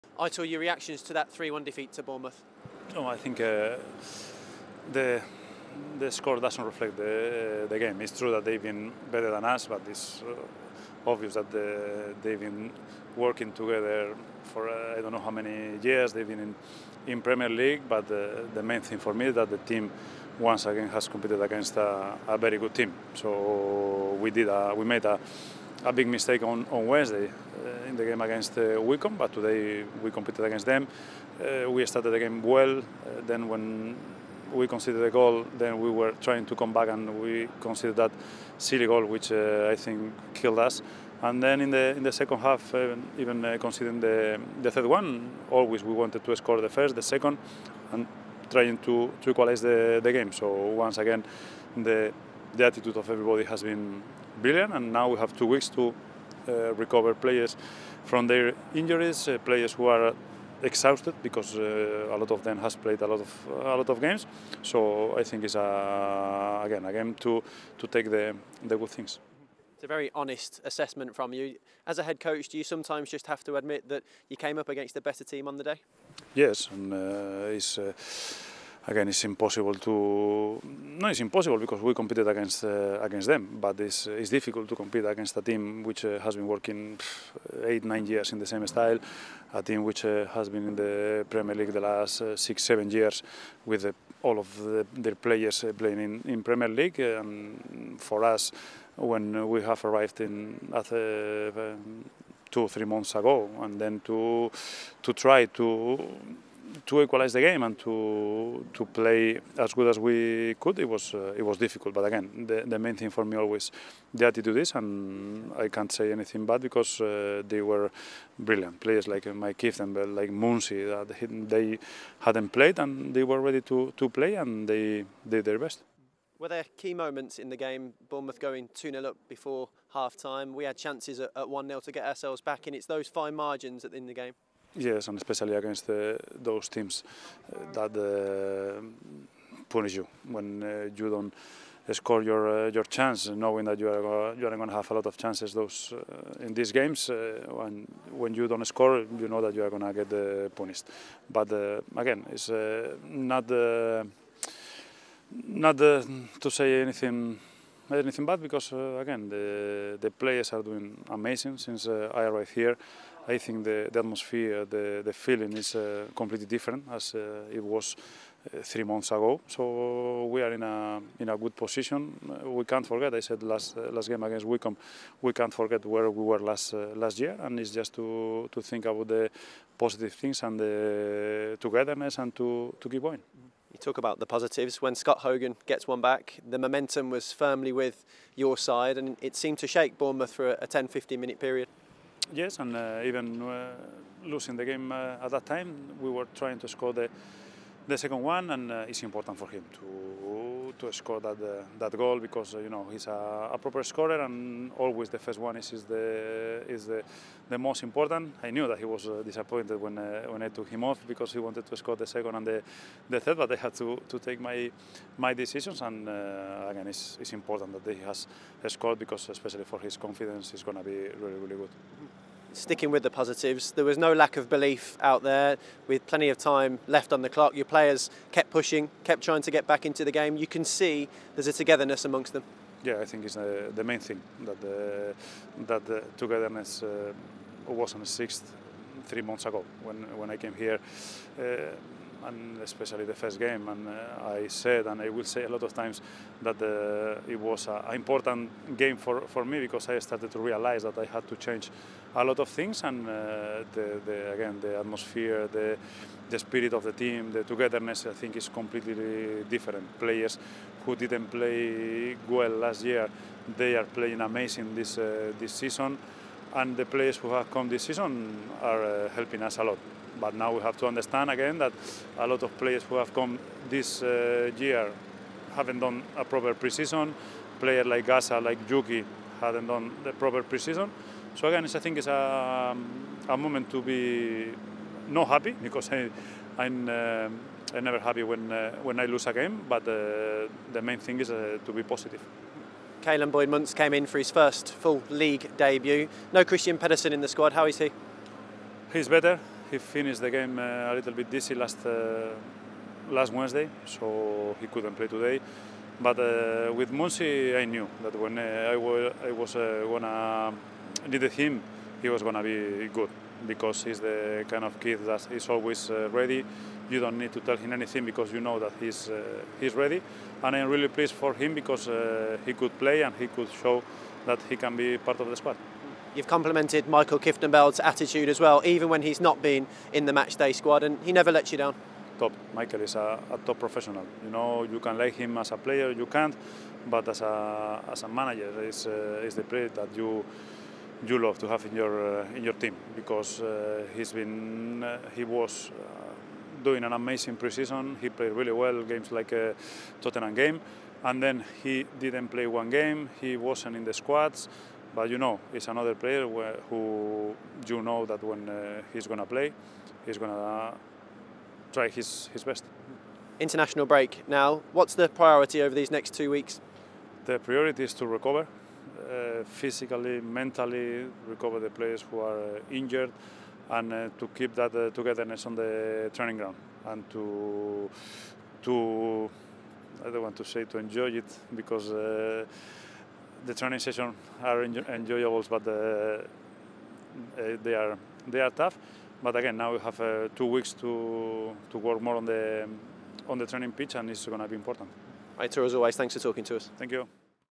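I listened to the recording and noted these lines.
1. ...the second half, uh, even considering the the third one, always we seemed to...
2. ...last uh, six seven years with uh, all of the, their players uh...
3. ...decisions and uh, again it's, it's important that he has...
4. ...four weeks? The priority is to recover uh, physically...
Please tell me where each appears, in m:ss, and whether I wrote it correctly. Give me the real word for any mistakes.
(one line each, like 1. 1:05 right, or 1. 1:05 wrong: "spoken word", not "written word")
1. 0:42 wrong: "wanted", not "seemed"
2. 1:31 right
3. 3:35 right
4. 6:06 wrong: "two", not "four".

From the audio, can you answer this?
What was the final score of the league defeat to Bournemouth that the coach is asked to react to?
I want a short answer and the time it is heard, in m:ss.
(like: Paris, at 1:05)
3-1, at 0:01.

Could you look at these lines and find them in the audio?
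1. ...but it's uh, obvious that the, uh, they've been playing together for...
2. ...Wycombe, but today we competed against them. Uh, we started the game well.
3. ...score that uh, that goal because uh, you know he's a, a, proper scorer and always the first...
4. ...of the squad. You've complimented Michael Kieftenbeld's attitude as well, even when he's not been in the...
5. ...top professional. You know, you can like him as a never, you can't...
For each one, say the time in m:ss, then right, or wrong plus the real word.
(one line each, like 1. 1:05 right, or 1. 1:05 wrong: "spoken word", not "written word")
1. 0:09 wrong: "working", not "playing"
2. 0:28 right
3. 3:20 right
4. 5:25 right
5. 5:33 wrong: "player", not "never".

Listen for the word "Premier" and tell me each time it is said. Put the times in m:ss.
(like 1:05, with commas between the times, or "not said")
0:17, 1:31, 1:36.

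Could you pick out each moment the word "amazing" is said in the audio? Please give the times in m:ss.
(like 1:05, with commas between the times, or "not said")
2:41, 4:24, 5:46.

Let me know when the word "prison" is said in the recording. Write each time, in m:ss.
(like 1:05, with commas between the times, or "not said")
not said.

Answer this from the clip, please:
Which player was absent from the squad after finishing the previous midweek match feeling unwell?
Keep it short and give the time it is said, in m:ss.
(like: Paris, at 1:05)
Kristian Pedersen, at 4:56.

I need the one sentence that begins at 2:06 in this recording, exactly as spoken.
Were there key moments in the game?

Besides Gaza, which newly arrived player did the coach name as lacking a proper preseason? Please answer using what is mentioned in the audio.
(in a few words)
Yuki.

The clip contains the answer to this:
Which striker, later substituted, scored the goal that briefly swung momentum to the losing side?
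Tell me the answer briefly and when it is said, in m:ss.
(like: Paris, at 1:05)
Scott Hogan, at 3:04.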